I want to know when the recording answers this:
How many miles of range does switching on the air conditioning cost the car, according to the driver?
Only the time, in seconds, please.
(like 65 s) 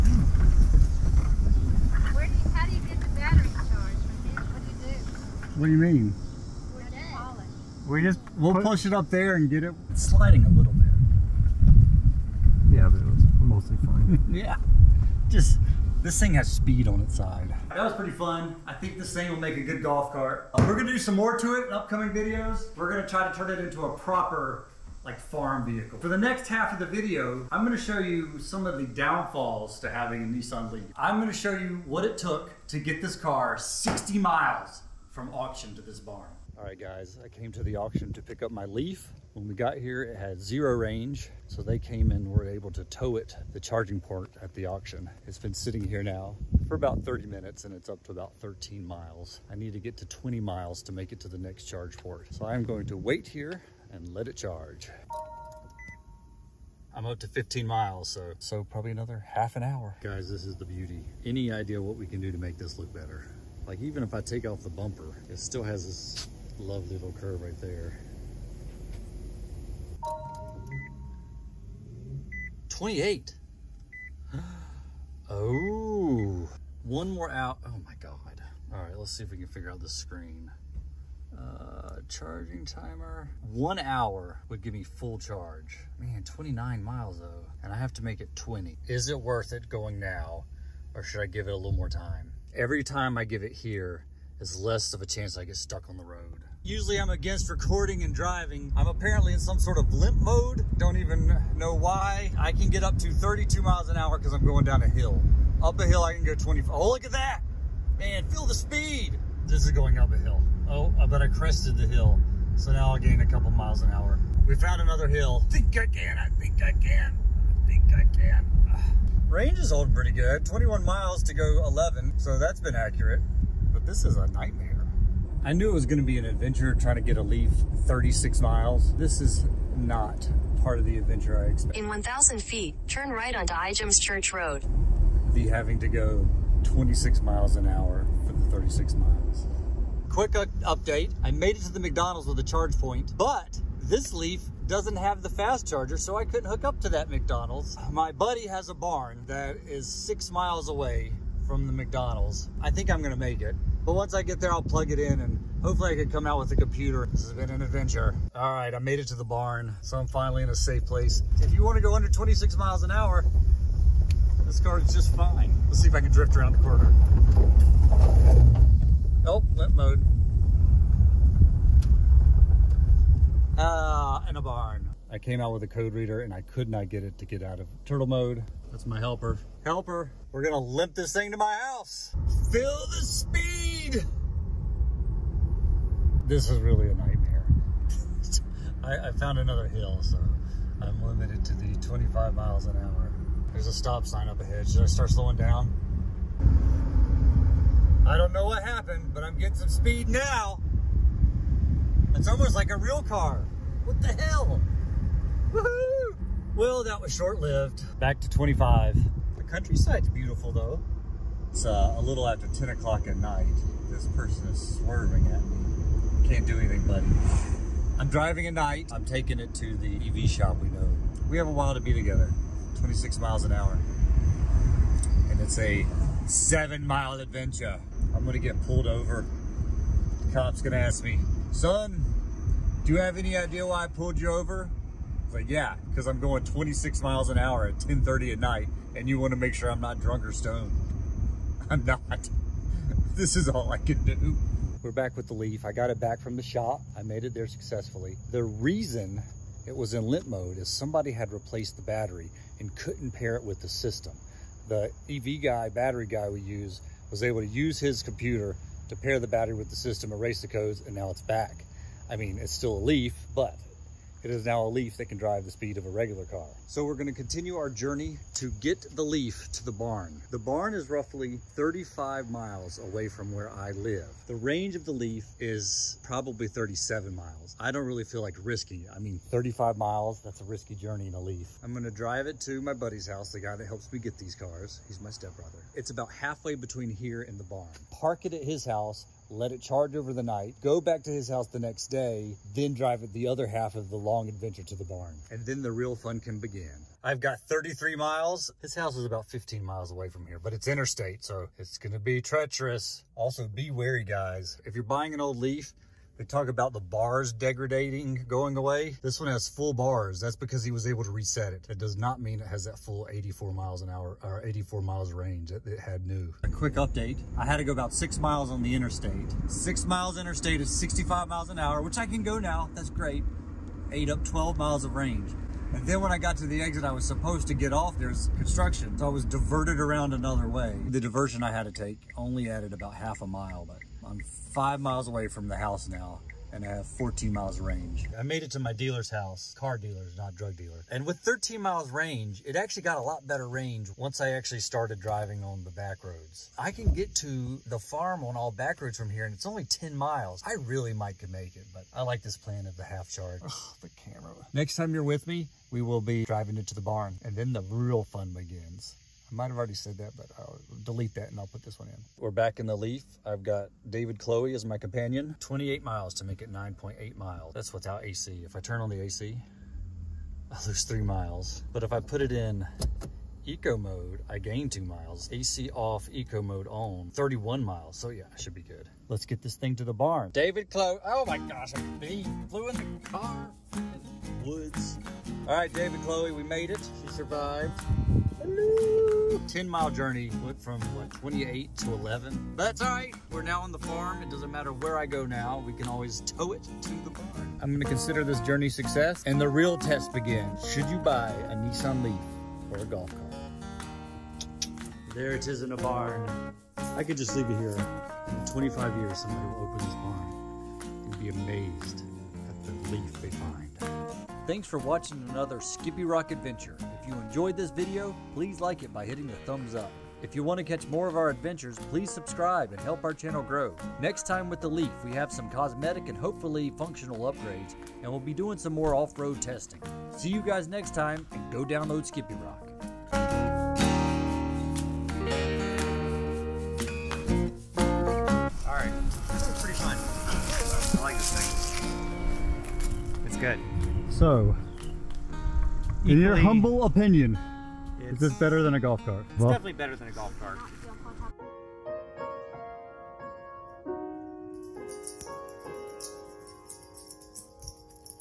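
370 s.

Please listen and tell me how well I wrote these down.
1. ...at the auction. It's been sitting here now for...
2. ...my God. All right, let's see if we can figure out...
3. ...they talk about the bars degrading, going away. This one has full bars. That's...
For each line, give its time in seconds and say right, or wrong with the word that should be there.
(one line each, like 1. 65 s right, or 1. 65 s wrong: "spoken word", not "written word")
1. 44 s right
2. 77 s right
3. 306 s right.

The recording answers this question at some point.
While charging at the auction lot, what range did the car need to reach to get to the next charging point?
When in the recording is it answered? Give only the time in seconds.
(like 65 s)
50 s.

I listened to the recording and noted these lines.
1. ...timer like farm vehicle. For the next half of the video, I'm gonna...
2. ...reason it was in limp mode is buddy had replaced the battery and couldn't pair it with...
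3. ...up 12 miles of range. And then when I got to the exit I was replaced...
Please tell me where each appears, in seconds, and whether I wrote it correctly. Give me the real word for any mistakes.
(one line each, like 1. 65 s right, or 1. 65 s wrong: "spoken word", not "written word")
1. 23 s wrong: "proper", not "timer"
2. 248 s wrong: "somebody", not "buddy"
3. 324 s wrong: "supposed", not "replaced".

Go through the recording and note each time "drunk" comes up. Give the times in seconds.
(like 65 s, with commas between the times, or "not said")
239 s.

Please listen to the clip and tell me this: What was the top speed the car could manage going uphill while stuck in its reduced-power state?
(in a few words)
25.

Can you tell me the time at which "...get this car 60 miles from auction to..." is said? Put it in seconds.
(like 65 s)
32 s.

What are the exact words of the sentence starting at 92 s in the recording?
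Every time I give it here is less of a chance I get stuck on the road.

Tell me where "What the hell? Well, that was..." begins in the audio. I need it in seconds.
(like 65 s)
203 s.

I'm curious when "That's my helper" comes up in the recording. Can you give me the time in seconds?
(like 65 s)
178 s.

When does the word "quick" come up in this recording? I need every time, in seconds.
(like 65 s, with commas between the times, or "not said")
140 s, 316 s.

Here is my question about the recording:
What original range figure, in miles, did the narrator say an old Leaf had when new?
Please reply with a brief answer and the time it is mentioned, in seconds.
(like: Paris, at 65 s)
84, at 314 s.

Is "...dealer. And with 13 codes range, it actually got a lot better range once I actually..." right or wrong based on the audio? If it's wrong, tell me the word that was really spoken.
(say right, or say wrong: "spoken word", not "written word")
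wrong: "miles", not "codes".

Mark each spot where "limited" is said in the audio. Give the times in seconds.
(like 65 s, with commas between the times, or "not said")
191 s.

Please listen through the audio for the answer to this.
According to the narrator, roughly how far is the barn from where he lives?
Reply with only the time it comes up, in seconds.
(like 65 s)
270 s.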